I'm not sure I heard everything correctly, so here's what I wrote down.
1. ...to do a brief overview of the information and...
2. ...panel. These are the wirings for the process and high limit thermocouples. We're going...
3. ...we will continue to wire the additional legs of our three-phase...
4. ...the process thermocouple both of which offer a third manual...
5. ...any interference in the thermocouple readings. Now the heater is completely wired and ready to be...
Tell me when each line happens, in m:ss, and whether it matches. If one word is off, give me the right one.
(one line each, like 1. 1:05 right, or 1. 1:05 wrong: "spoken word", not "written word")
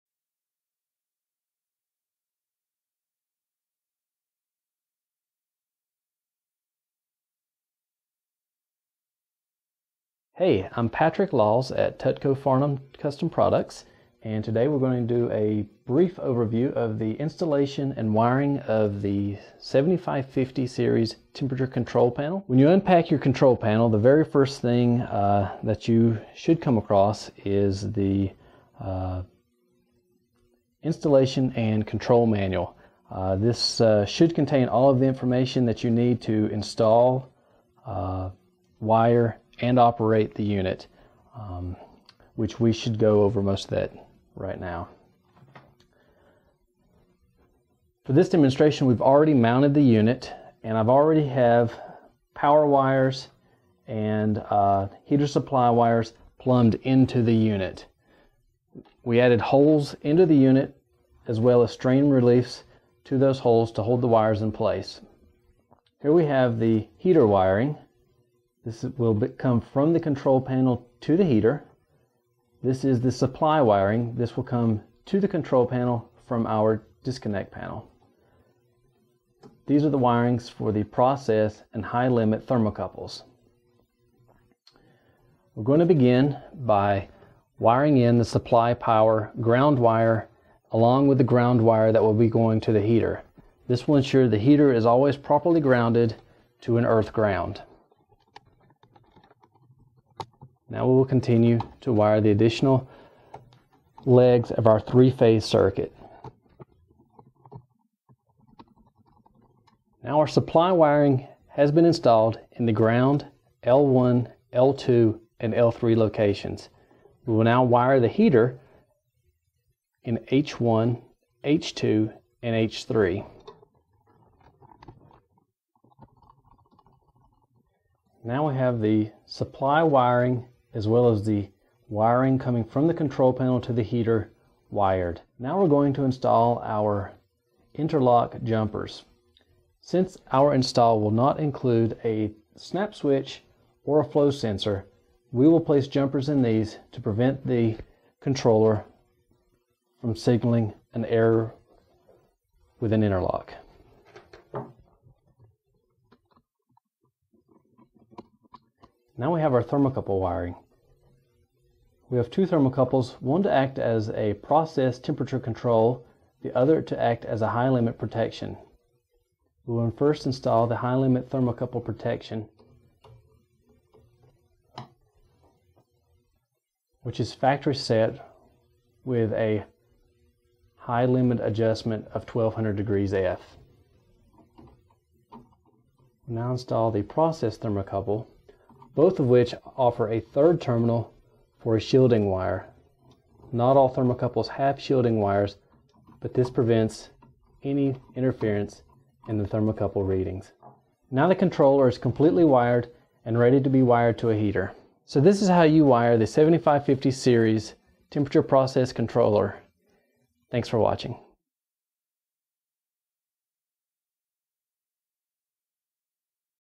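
1. 0:15 wrong: "installation", not "information"
2. 1:17 right
3. 1:40 right
4. 3:06 wrong: "terminal", not "manual"
5. 3:17 wrong: "controller", not "heater".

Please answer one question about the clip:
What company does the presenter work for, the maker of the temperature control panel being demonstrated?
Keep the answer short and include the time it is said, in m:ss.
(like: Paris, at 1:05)
Tutco Farnam Custom Products, at 0:11.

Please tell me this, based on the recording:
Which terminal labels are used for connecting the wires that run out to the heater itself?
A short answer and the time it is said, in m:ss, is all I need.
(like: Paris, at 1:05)
H1, H2, and H3, at 2:00.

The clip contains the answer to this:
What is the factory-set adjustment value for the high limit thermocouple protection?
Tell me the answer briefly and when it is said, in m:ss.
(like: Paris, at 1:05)
1200 degrees F, at 3:02.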